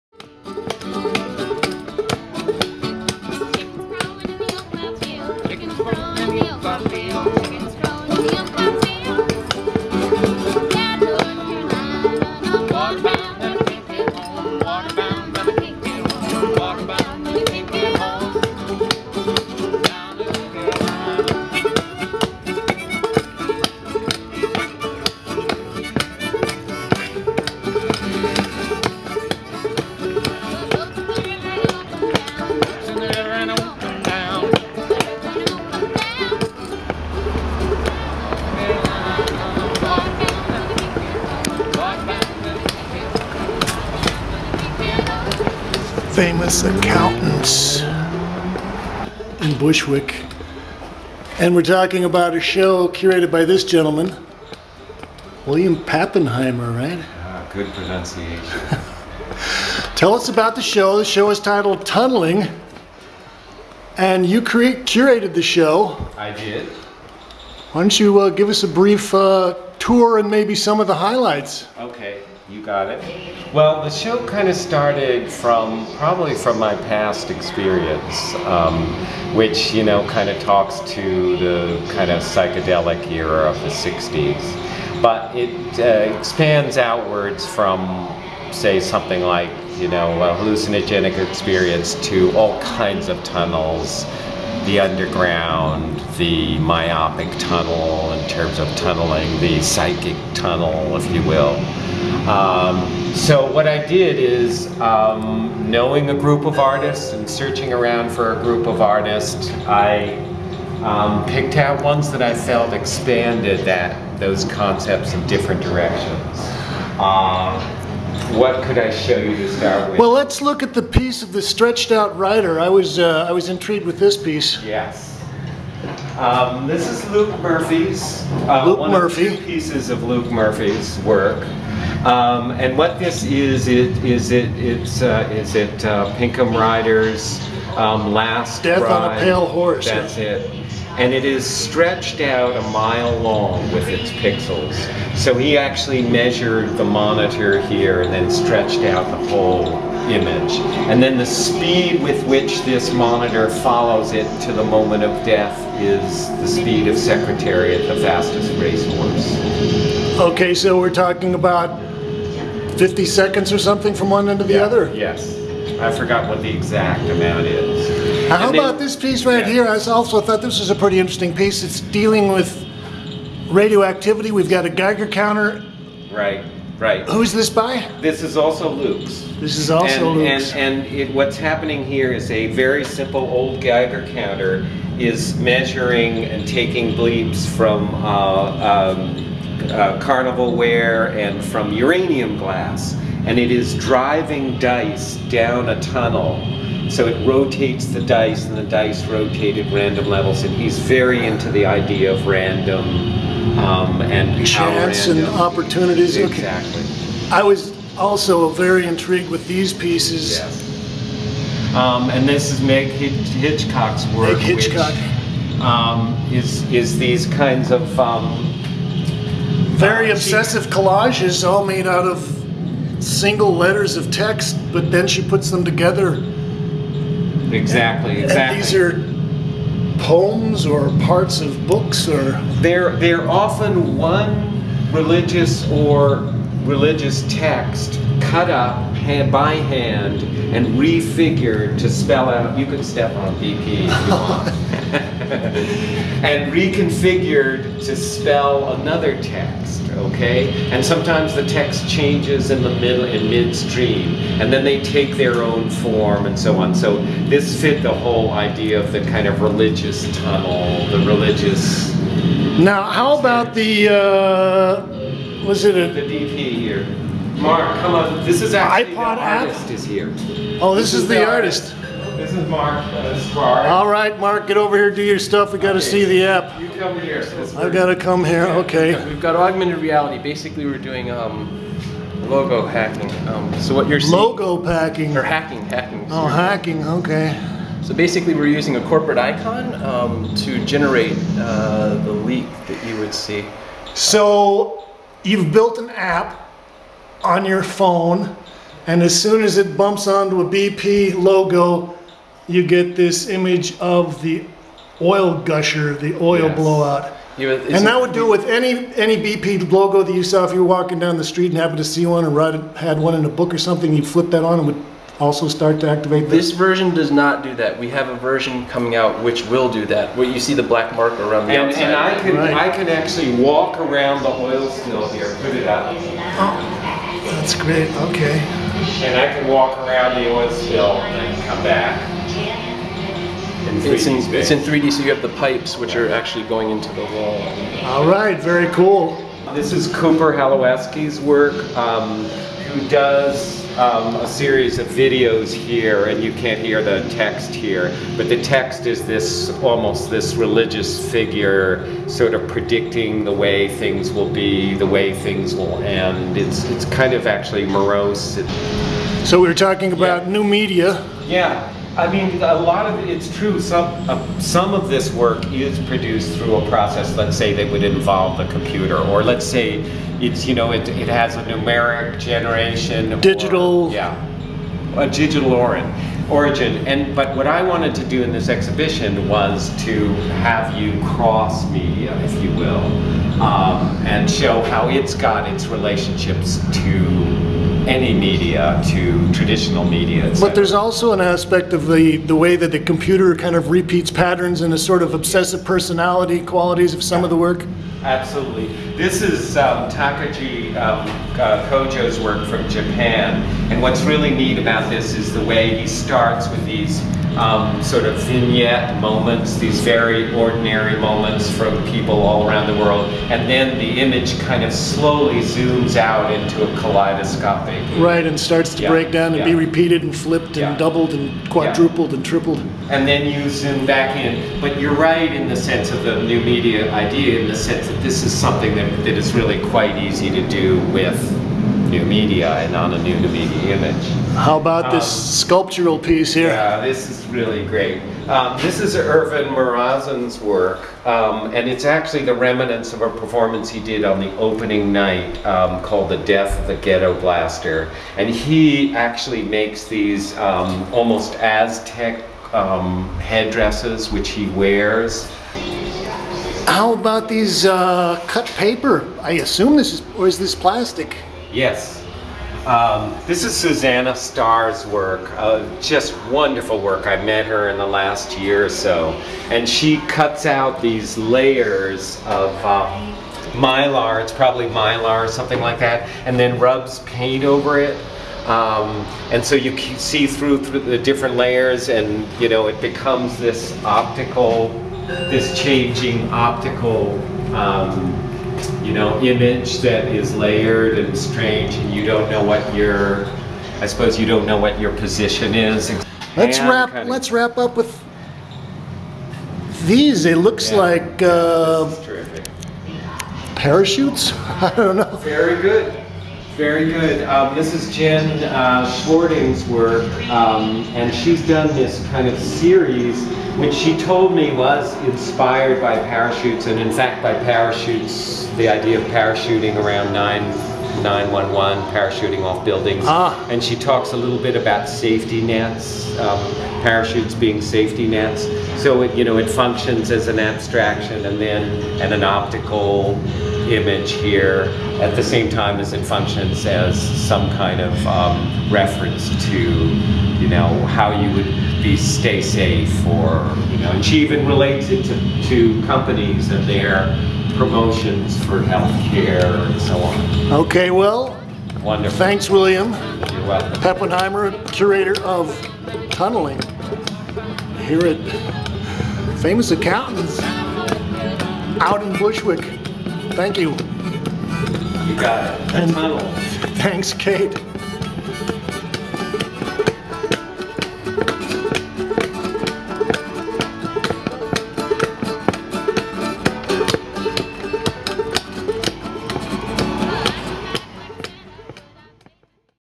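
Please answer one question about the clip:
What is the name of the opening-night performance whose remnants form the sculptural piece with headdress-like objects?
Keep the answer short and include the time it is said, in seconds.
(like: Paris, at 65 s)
The Death of the Ghetto Blaster, at 446 s.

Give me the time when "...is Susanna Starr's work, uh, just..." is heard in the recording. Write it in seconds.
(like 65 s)
463 s.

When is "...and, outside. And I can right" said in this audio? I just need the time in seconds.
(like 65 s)
321 s.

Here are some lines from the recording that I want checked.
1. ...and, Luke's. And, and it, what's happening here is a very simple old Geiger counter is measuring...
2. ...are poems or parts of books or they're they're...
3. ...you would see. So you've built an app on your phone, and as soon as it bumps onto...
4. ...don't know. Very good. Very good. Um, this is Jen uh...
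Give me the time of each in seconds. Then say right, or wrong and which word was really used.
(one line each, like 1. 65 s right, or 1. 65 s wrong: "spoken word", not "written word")
1. 180 s right
2. 228 s right
3. 292 s right
4. 504 s right.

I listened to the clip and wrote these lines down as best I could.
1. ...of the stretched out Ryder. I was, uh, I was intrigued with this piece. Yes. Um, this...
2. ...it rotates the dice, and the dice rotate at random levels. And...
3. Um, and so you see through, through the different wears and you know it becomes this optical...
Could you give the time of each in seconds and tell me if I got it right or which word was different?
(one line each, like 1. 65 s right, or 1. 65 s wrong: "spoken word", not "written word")
1. 121 s right
2. 197 s right
3. 478 s wrong: "layers", not "wears".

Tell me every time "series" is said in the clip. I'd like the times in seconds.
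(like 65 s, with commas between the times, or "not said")
344 s, 512 s.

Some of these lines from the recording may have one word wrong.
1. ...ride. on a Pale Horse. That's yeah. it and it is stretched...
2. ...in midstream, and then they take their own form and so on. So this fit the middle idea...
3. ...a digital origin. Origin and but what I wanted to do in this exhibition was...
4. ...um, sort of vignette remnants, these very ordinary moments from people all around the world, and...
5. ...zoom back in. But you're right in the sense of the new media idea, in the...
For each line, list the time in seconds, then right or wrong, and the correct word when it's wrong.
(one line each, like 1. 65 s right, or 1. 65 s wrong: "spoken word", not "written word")
1. 138 s right
2. 253 s wrong: "whole", not "middle"
3. 374 s right
4. 407 s wrong: "moments", not "remnants"
5. 423 s right.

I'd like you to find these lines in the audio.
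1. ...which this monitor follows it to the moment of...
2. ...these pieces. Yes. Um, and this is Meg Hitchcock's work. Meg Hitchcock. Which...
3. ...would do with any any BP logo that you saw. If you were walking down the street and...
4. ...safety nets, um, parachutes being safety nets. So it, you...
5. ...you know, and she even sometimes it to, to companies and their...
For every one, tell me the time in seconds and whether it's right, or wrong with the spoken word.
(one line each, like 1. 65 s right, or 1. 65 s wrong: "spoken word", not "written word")
1. 152 s right
2. 209 s right
3. 307 s right
4. 524 s right
5. 543 s wrong: "relates", not "sometimes".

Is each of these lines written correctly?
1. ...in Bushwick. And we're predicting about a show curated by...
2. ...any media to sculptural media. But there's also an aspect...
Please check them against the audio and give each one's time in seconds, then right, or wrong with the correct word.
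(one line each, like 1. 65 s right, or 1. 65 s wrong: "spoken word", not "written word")
1. 49 s wrong: "talking", not "predicting"
2. 387 s wrong: "traditional", not "sculptural".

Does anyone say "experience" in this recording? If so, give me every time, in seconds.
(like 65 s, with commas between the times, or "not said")
77 s, 91 s.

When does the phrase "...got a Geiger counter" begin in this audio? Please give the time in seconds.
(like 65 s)
174 s.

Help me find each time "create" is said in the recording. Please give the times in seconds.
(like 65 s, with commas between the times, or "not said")
64 s.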